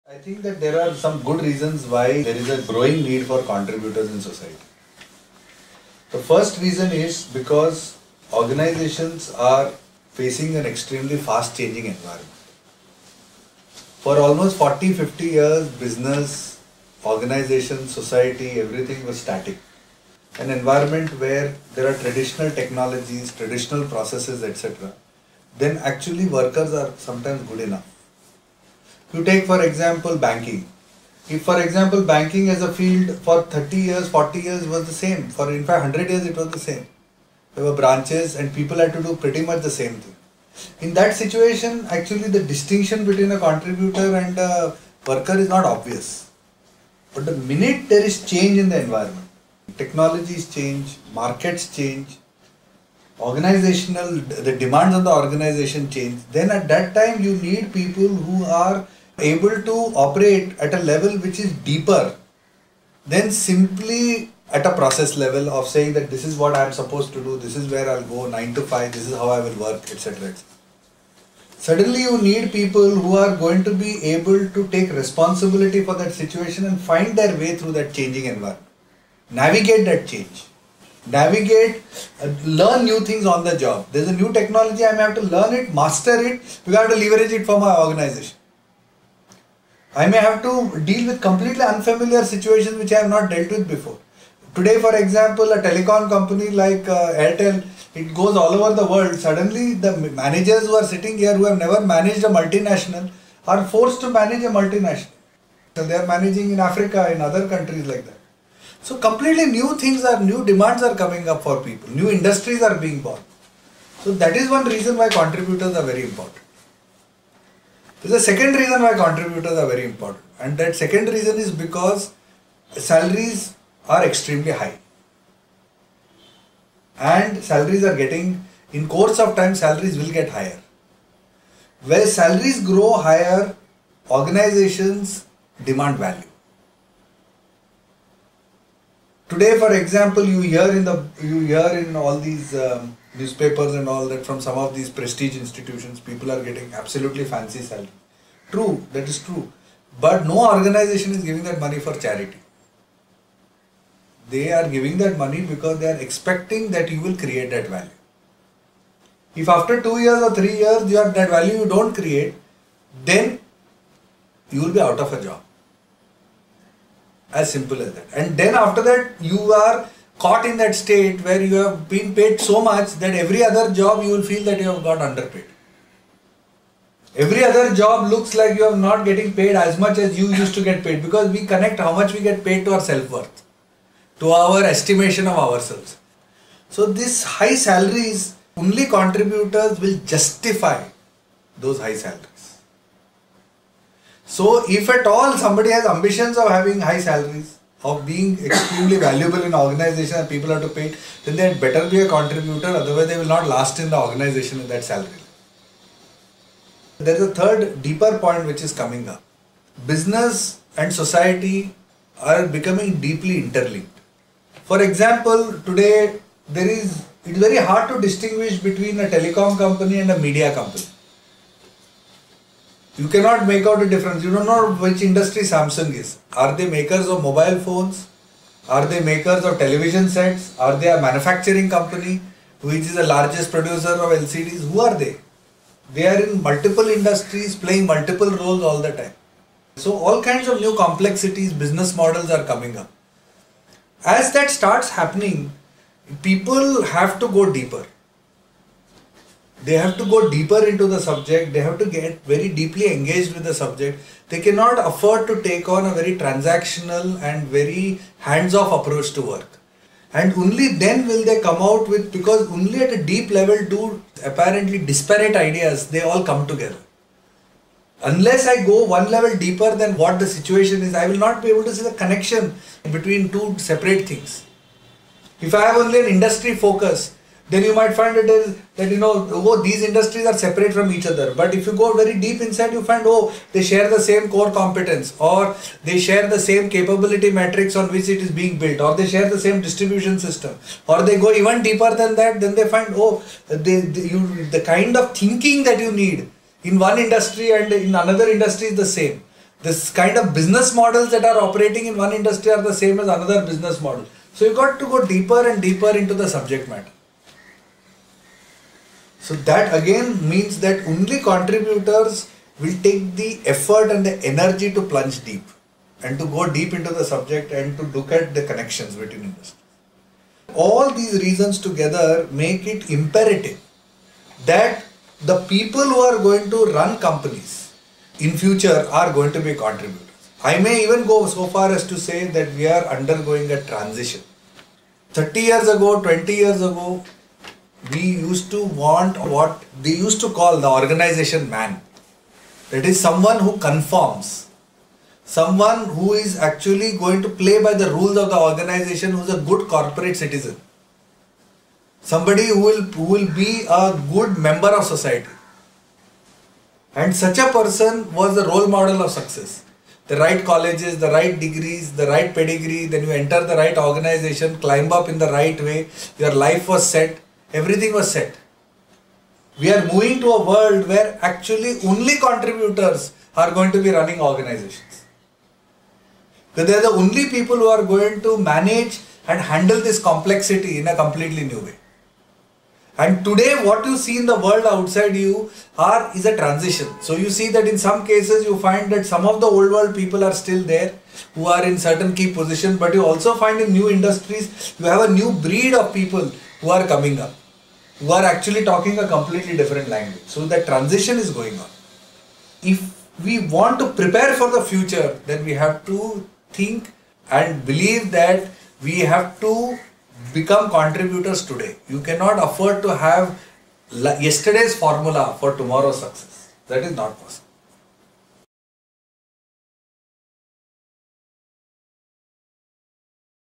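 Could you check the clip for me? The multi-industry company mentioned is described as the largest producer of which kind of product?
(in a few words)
LCDs.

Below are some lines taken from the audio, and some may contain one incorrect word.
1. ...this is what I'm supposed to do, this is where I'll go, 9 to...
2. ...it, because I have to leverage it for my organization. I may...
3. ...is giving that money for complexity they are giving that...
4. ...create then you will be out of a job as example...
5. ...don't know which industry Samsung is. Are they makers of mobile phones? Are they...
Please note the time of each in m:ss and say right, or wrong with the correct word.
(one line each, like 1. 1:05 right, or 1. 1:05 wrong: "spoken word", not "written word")
1. 1:06 right
2. 1:26 right
3. 2:31 wrong: "charity", not "complexity"
4. 2:42 wrong: "simple", not "example"
5. 3:44 right.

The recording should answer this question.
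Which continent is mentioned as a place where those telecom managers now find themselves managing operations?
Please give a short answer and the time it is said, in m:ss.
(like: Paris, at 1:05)
Africa, at 1:46.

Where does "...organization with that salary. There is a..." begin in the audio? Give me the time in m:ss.
3:23.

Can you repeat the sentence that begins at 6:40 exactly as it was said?
So that transition is going on.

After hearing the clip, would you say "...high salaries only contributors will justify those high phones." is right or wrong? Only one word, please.
wrong.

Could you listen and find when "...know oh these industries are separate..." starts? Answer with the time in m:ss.
4:39.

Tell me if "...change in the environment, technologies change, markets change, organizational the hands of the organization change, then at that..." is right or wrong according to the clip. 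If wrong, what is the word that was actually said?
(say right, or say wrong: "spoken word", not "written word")
wrong: "demands", not "hands".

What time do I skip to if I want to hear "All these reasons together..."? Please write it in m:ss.
5:20.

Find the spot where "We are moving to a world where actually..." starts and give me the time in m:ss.
6:09.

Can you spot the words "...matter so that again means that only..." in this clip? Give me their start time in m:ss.
5:06.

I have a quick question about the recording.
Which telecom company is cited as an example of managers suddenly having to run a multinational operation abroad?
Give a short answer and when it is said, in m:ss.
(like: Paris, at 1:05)
Airtel, at 1:37.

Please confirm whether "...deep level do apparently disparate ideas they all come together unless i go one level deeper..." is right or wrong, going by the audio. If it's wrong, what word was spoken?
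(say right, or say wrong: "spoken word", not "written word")
right.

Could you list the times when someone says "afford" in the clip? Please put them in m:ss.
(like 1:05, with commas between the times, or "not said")
4:14, 6:52.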